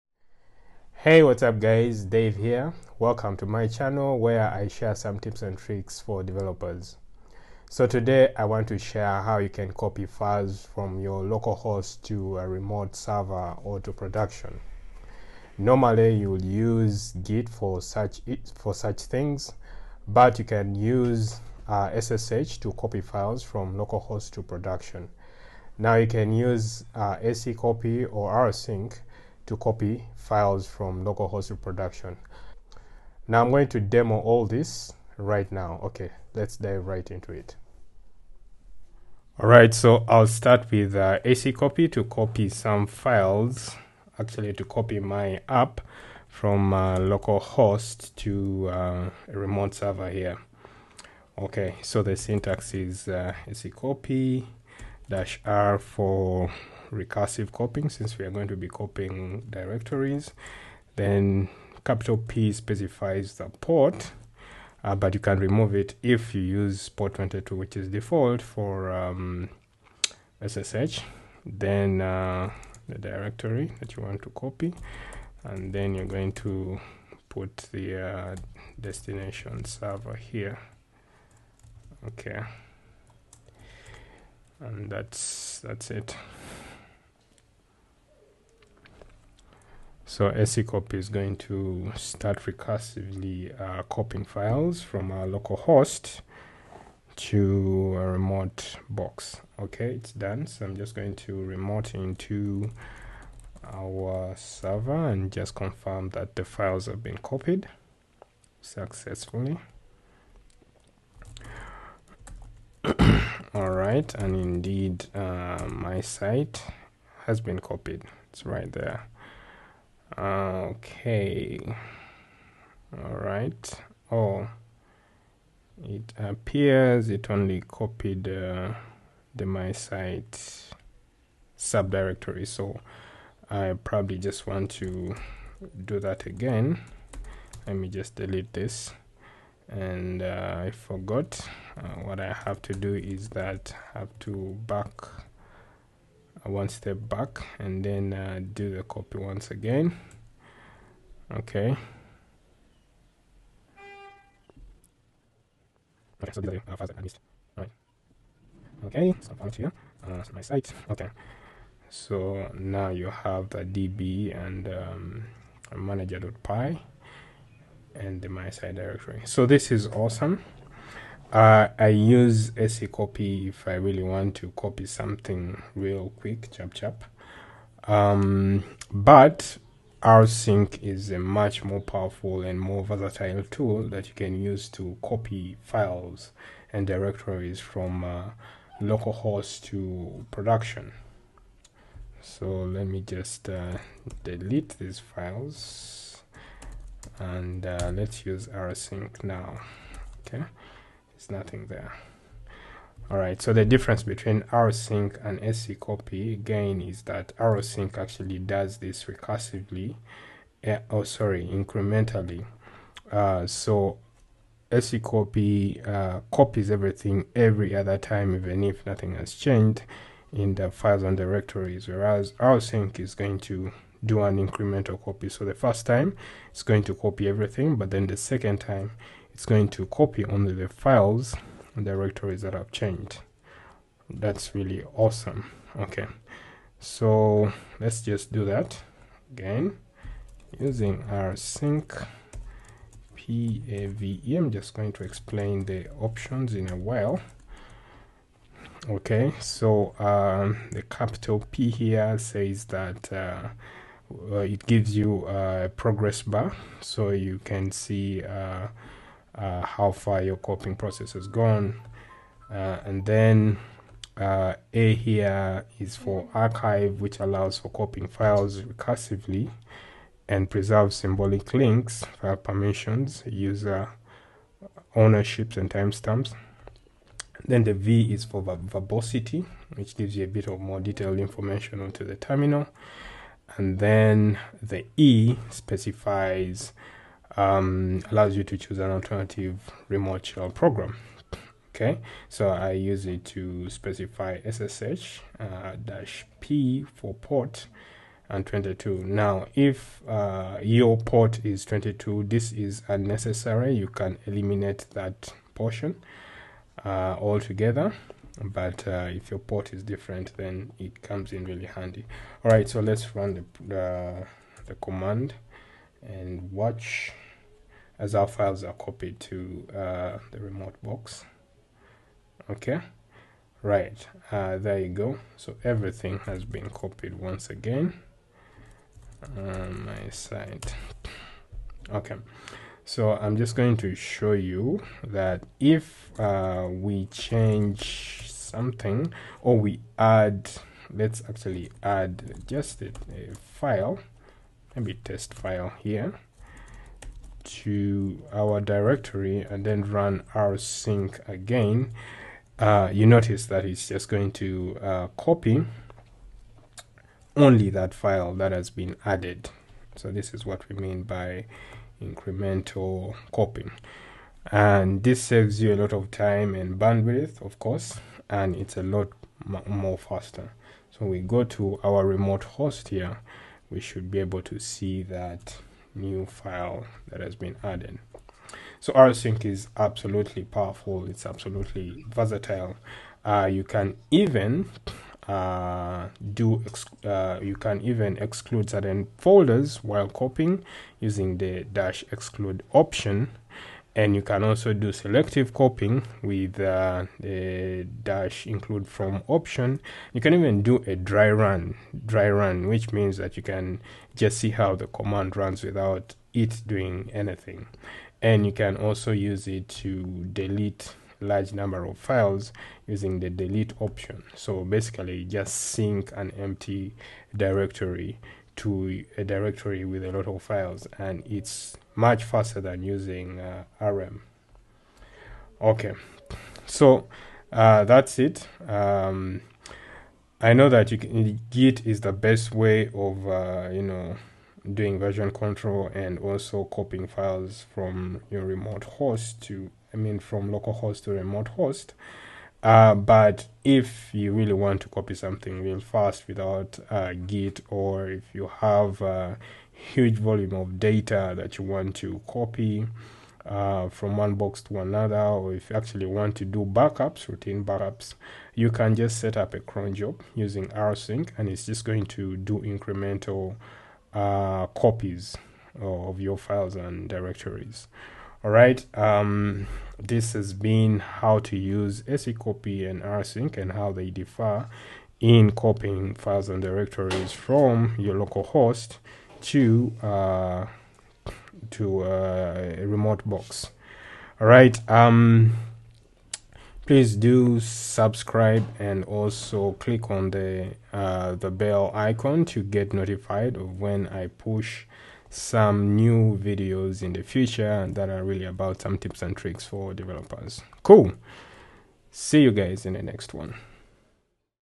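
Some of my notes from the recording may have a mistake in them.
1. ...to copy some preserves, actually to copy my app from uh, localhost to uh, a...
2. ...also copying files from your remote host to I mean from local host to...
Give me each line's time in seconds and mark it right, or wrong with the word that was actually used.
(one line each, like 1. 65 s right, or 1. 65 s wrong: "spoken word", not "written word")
1. 41 s wrong: "files", not "preserves"
2. 436 s right.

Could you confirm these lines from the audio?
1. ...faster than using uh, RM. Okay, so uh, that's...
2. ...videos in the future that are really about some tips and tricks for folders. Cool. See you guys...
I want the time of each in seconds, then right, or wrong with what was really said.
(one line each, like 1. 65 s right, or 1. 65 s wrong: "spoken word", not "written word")
1. 422 s right
2. 496 s wrong: "developers", not "folders".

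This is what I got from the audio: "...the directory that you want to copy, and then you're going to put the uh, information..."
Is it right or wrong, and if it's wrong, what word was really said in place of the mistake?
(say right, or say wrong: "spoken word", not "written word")
wrong: "destination", not "information".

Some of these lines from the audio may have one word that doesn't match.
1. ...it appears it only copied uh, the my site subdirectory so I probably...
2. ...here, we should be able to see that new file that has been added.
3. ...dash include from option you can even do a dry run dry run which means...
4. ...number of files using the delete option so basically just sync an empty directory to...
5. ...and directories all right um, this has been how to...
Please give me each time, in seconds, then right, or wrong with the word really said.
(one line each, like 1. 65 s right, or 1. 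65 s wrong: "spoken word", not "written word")
1. 125 s right
2. 372 s right
3. 398 s right
4. 411 s right
5. 466 s right.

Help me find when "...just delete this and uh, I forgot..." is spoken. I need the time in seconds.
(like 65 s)
137 s.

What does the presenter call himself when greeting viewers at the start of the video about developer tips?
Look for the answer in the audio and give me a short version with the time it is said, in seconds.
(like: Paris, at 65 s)
Dave, at 2 s.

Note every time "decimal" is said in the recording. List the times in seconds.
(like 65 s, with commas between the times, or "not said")
not said.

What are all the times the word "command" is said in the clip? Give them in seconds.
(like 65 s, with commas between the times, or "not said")
314 s, 404 s.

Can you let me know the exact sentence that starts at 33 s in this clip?
Now I'm going to demo all this right now.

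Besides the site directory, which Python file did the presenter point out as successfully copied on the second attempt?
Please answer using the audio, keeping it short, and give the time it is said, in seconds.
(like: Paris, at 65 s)
manager.py, at 165 s.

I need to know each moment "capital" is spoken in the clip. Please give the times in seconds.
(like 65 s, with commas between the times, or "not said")
61 s, 250 s.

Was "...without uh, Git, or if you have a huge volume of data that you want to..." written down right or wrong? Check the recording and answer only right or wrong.
right.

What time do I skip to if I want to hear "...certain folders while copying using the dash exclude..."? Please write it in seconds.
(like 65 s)
388 s.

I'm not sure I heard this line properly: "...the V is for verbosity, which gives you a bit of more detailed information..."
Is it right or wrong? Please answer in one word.
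right.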